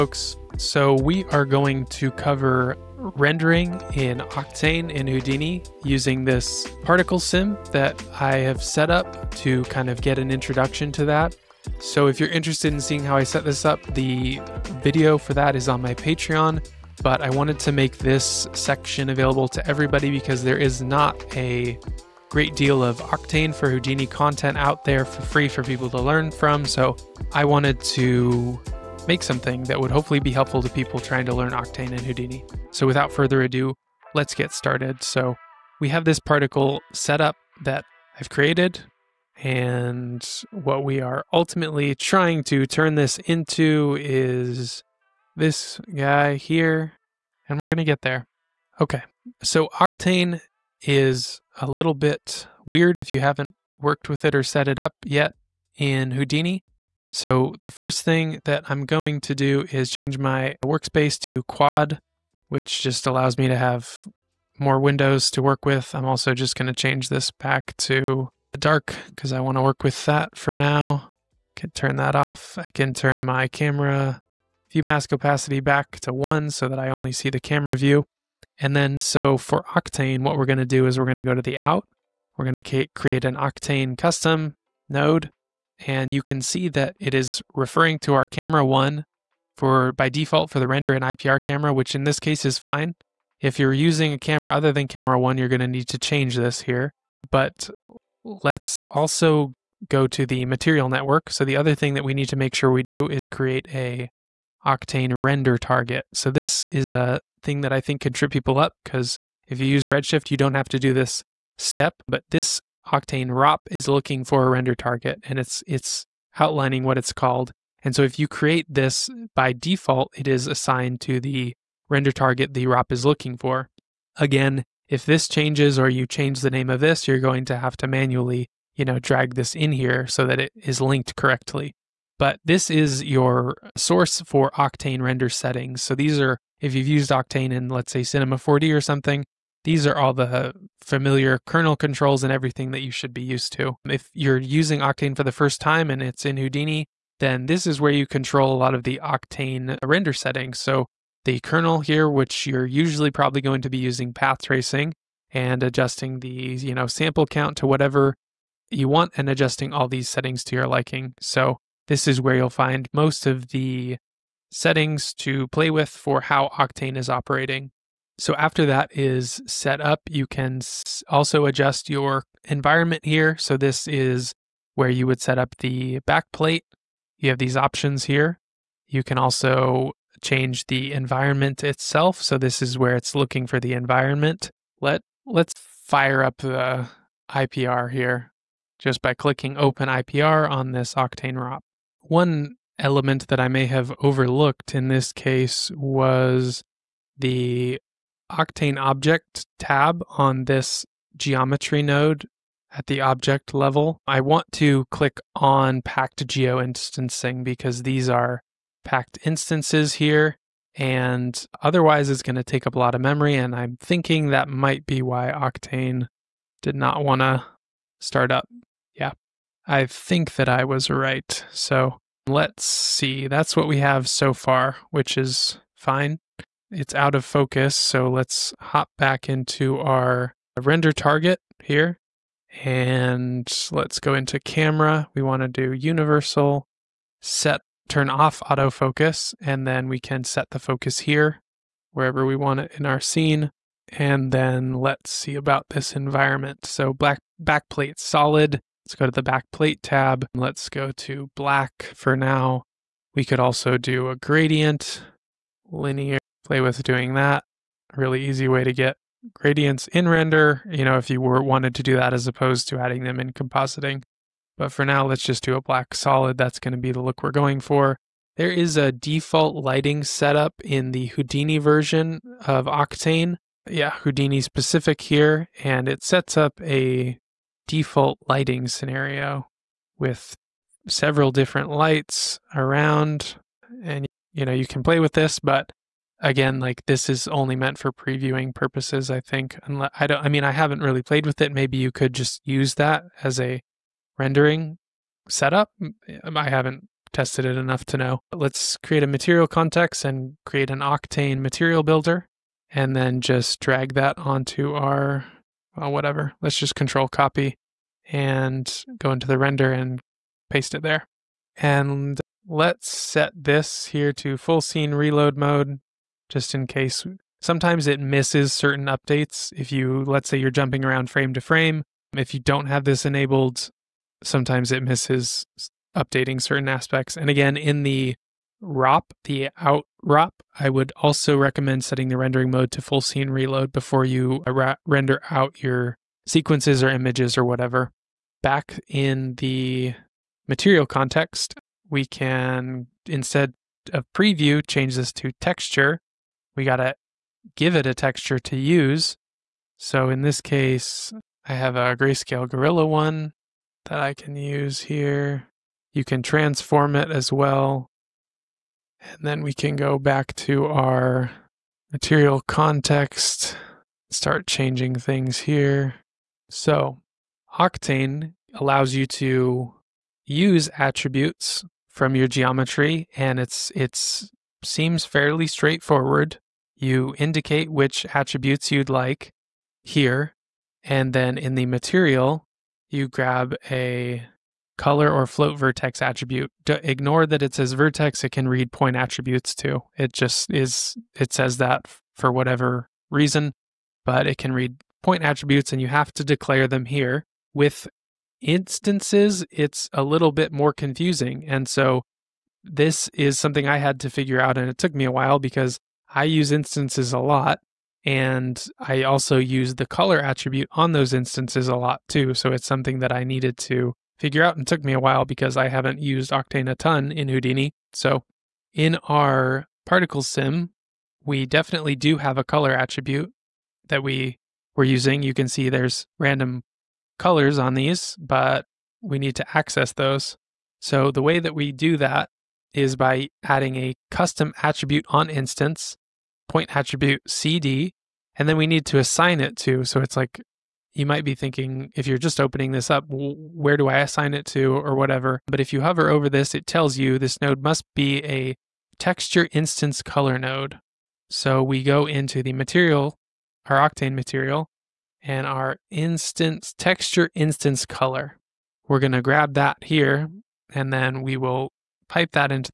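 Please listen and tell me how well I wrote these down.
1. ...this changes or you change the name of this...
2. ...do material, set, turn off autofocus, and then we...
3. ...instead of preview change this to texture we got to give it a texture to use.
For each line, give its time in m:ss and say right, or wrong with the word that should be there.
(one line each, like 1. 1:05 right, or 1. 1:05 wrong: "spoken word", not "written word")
1. 2:05 right
2. 3:55 wrong: "universal", not "material"
3. 5:43 right.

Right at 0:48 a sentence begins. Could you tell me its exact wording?
Okay, so Octane is a little bit weird if you haven't worked with it or set it up yet in Houdini.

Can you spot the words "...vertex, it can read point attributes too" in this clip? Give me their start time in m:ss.
6:27.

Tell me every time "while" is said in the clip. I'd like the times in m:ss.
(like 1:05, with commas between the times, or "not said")
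6:45, 6:54.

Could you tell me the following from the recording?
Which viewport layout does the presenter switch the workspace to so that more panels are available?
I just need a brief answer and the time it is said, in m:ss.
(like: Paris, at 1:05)
Quad, at 1:01.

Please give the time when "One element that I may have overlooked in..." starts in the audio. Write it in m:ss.
3:12.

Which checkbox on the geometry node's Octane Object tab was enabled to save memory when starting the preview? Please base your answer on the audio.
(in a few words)
Packed geo instancing.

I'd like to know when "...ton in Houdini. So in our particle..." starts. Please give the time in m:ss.
6:56.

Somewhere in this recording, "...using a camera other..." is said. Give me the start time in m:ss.
1:33.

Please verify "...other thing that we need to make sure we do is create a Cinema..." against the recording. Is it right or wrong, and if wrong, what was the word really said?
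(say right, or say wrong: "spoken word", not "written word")
wrong: "Octane", not "Cinema".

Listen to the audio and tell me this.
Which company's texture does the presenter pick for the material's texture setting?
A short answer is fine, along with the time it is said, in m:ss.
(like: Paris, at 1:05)
Greyscalegorilla, at 5:51.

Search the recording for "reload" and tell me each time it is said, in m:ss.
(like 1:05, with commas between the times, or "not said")
5:14, 5:33.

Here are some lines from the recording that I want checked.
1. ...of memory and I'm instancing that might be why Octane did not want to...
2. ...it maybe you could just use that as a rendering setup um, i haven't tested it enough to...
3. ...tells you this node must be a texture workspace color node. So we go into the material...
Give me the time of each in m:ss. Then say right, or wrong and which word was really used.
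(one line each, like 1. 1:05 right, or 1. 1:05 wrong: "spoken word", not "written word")
1. 3:32 wrong: "thinking", not "instancing"
2. 4:51 right
3. 7:26 wrong: "instance", not "workspace".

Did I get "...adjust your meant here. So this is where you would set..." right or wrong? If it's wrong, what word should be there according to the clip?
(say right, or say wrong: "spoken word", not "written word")
wrong: "environment", not "meant".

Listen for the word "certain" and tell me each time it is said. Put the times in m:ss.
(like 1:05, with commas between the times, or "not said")
5:18, 5:26.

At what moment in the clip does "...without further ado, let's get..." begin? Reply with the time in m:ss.
0:32.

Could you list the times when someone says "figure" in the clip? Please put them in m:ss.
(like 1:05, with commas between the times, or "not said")
6:44, 6:54.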